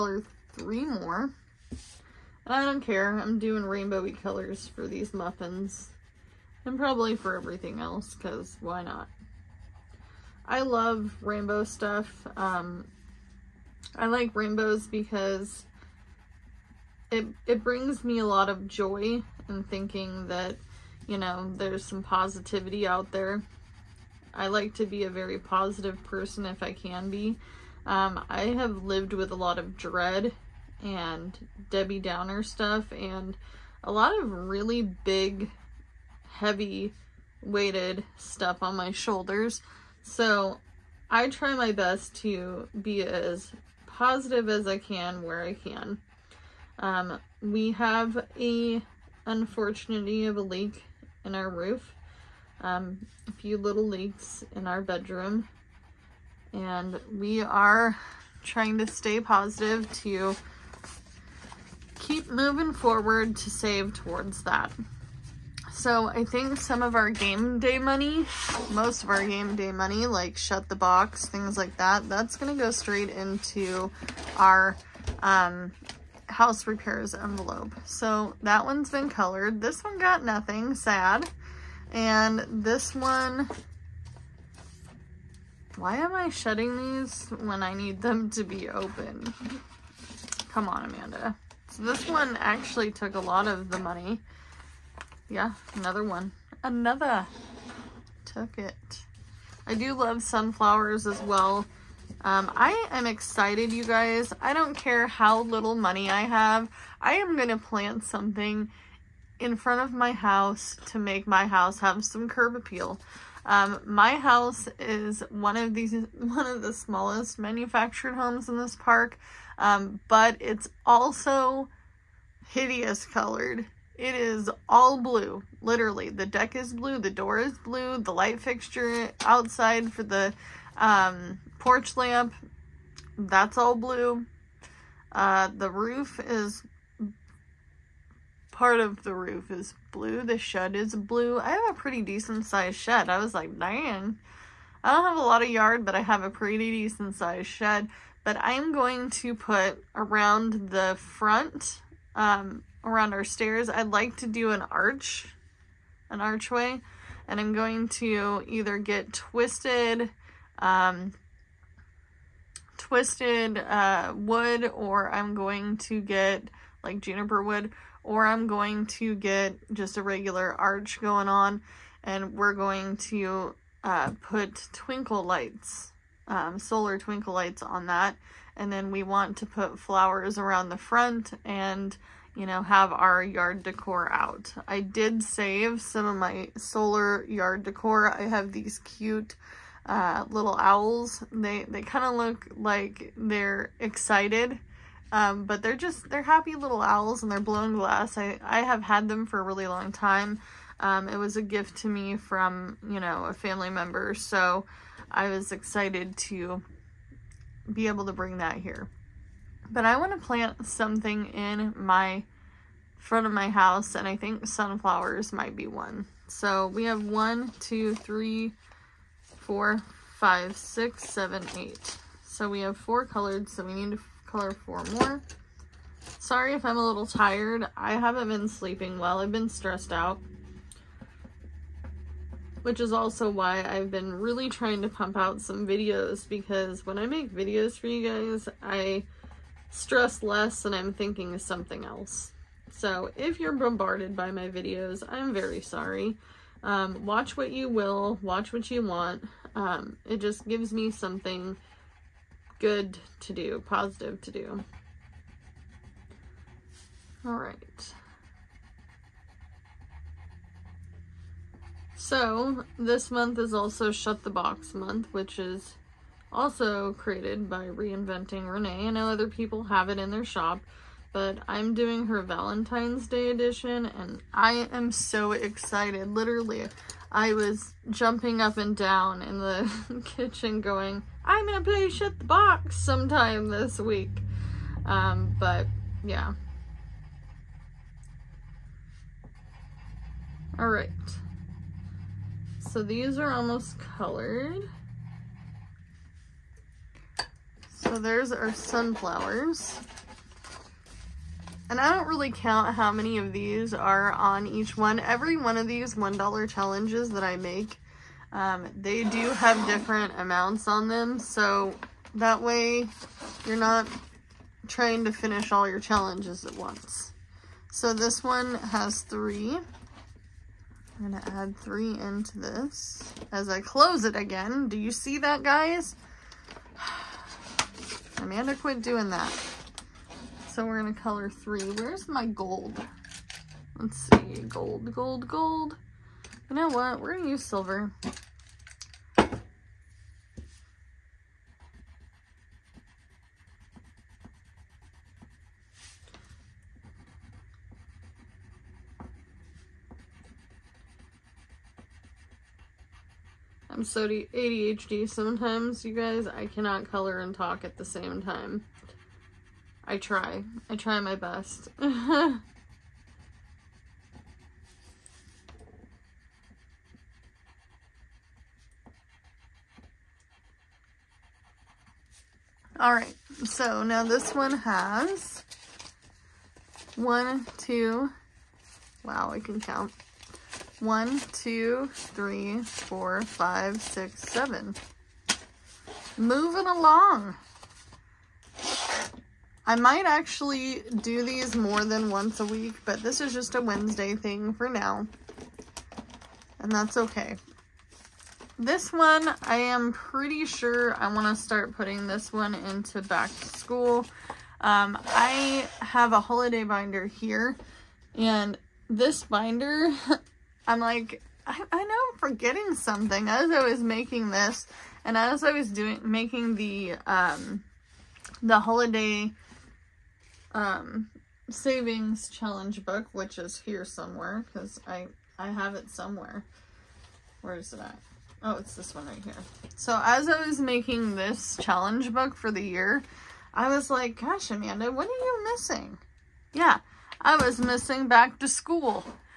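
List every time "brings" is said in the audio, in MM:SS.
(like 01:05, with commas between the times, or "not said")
00:17, 03:28.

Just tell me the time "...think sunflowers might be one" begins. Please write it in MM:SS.
03:34.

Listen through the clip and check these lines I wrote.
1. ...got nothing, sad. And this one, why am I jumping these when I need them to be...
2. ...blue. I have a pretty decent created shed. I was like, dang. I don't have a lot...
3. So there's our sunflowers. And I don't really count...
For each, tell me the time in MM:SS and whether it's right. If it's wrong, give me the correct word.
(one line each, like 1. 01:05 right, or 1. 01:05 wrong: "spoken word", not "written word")
1. 01:19 wrong: "shutting", not "jumping"
2. 02:20 wrong: "sized", not "created"
3. 04:57 right.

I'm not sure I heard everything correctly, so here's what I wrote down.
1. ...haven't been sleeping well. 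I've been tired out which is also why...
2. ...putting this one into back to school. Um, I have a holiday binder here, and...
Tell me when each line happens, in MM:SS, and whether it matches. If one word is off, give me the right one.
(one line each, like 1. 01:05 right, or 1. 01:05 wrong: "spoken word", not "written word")
1. 03:47 wrong: "stressed", not "tired"
2. 06:41 right.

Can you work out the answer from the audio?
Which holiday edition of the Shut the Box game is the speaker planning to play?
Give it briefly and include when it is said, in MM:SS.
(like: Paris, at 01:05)
Valentine's Day, at 04:32.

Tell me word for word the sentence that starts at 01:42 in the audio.
Um, I am excited, you guys.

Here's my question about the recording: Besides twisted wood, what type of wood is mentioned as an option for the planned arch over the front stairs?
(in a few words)
Juniper.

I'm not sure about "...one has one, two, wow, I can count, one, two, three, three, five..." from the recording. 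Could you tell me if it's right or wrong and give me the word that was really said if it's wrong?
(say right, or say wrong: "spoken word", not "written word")
wrong: "four", not "three".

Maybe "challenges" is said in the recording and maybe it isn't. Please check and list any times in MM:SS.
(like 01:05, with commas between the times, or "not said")
05:06, 05:15, 07:02, 07:11.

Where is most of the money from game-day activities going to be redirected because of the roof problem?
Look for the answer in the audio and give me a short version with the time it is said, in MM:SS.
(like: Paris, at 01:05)
House repairs envelope, at 01:16.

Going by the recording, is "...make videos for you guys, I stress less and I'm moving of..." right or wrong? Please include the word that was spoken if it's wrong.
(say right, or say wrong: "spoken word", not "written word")
wrong: "thinking", not "moving".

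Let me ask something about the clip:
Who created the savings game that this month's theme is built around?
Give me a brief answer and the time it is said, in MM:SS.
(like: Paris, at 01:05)
Reinventing Renee, at 04:27.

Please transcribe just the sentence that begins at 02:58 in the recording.
And then we want to put flowers around the front and, you know, have our yard decor out.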